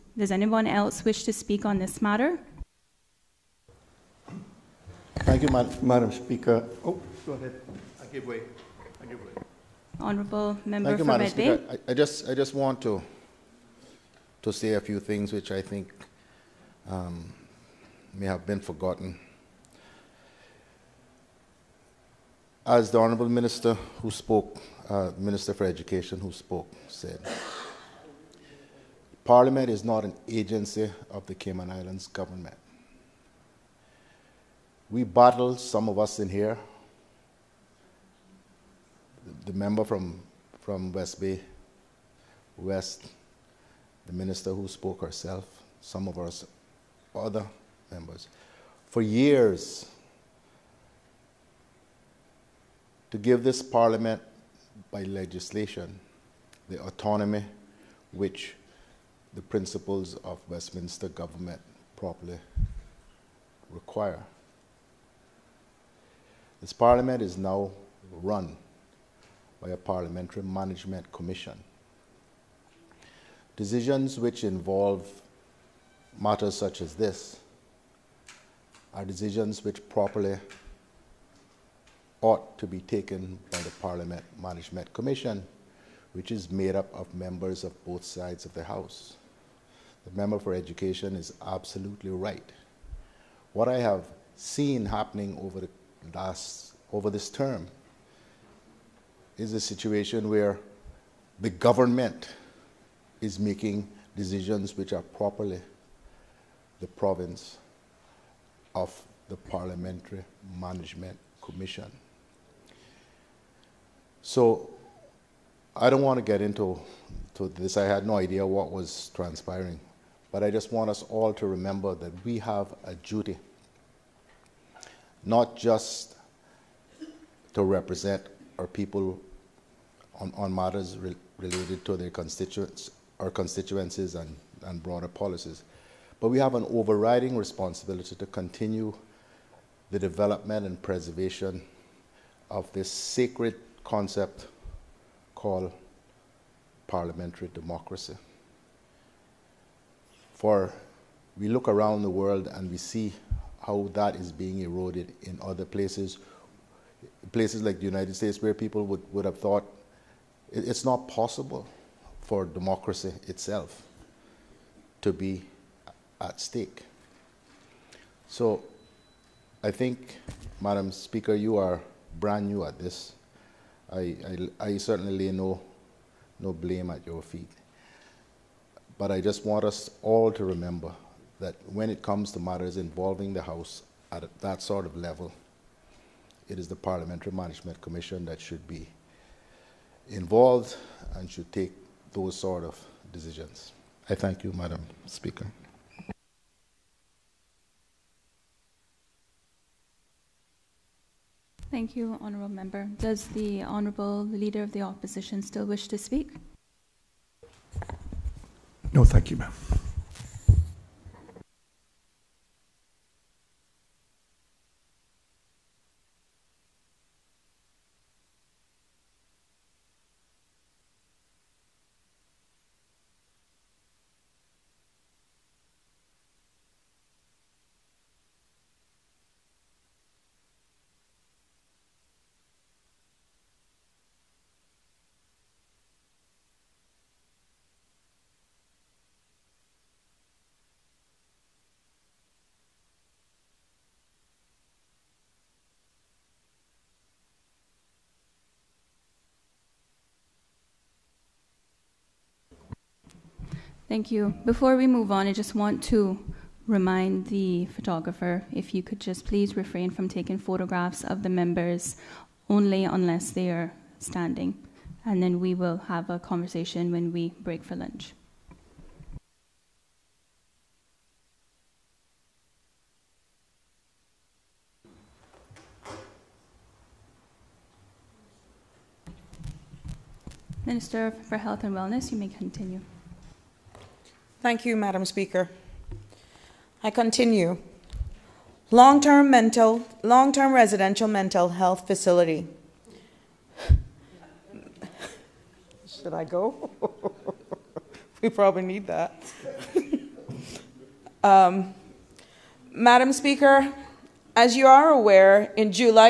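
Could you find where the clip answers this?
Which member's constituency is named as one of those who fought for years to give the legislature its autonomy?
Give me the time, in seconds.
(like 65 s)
40 s.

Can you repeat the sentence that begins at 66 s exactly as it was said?
This parliament is now run by a parliamentary management commission.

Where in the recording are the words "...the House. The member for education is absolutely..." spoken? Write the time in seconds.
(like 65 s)
88 s.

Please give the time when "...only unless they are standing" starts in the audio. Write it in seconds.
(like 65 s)
262 s.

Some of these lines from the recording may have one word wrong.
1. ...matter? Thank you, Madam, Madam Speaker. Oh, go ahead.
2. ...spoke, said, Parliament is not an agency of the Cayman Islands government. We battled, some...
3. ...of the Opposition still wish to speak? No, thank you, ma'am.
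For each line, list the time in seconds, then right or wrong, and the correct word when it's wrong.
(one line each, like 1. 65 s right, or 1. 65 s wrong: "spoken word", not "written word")
1. 2 s right
2. 26 s right
3. 204 s right.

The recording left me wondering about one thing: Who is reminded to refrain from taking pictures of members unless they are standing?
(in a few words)
The photographer.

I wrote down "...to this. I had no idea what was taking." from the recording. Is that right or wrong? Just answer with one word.
wrong.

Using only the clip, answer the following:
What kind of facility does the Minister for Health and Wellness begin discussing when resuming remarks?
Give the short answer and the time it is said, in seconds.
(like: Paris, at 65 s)
Long-term residential mental health facility, at 290 s.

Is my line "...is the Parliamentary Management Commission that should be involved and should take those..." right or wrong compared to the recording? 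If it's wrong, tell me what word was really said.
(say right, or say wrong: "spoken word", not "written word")
right.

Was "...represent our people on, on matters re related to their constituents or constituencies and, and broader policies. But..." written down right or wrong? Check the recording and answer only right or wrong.
right.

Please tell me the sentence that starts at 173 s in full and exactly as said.
I, I, I certainly lay no, no blame at your feet.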